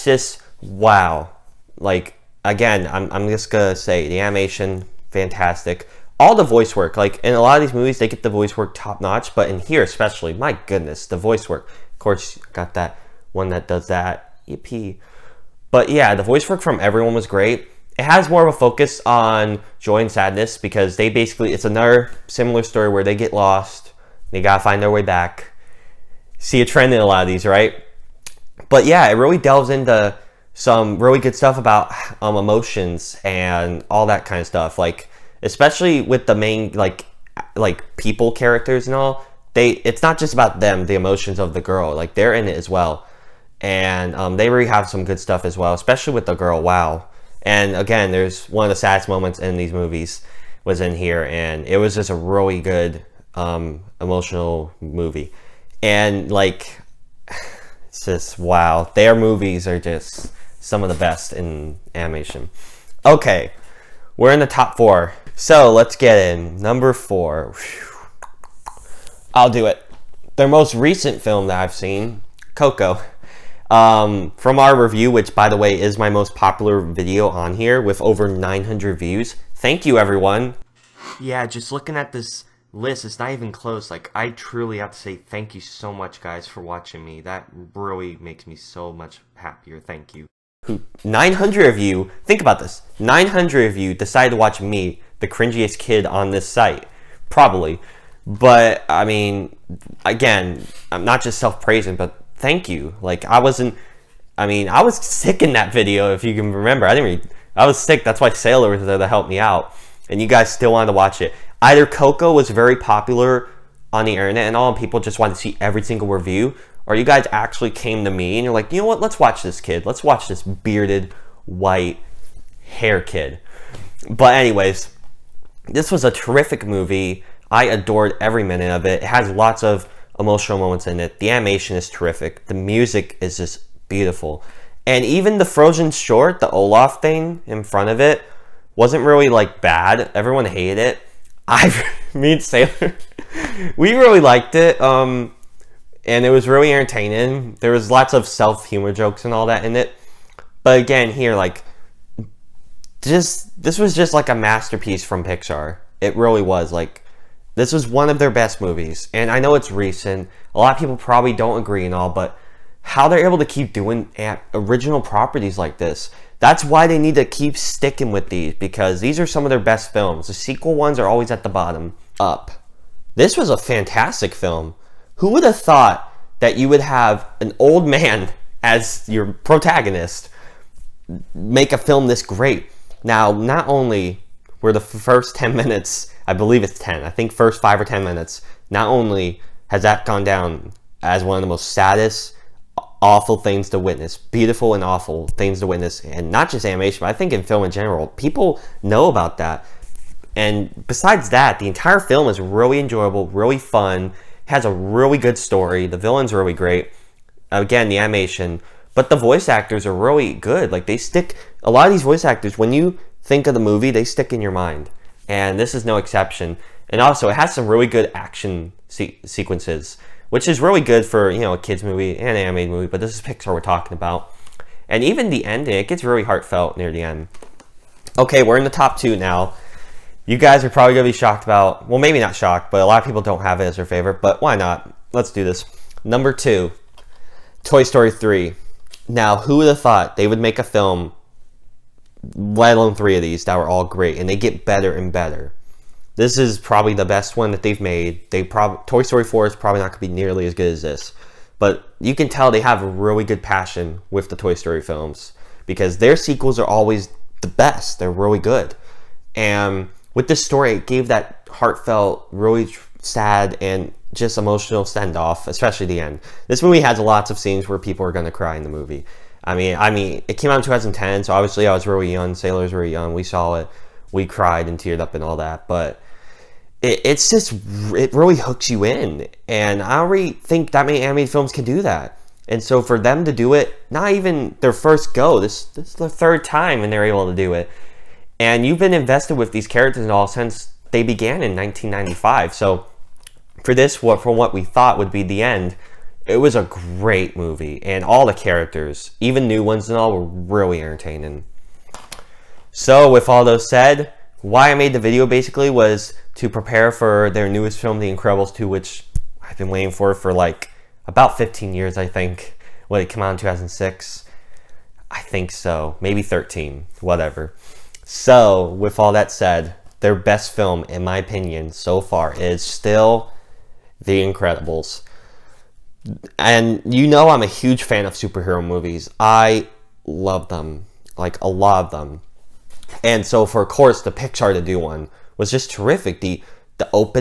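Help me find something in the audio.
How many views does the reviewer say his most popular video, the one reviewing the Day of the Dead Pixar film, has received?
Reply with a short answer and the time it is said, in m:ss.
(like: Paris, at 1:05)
over 900, at 1:18.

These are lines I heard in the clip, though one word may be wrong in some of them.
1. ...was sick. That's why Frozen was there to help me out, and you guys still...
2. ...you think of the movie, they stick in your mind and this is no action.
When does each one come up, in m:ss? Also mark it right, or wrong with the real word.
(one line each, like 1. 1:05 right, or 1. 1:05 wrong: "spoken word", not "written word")
1. 1:47 wrong: "Sailor", not "Frozen"
2. 3:32 wrong: "exception", not "action".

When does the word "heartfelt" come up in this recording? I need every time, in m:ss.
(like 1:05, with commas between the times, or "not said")
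3:46, 4:21.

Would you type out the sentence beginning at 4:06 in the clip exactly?
This is probably the best one that they've made.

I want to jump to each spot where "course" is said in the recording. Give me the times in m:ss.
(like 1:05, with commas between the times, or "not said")
0:11, 5:33.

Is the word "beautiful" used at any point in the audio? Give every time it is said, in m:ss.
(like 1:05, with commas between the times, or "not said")
2:13, 3:14.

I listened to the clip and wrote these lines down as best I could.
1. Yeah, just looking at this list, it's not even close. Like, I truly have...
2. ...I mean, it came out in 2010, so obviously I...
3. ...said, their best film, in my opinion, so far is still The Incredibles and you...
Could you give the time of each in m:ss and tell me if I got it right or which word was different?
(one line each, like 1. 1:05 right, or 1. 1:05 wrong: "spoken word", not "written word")
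1. 1:21 right
2. 4:29 right
3. 5:19 right.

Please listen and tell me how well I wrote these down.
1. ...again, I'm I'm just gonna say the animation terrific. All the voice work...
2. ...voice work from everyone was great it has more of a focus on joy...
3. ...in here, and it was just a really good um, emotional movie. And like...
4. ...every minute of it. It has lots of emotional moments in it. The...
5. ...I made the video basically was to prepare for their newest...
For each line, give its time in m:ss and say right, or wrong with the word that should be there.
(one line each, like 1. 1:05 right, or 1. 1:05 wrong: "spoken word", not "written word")
1. 0:02 wrong: "fantastic", not "terrific"
2. 0:16 right
3. 0:50 right
4. 2:08 right
5. 5:04 right.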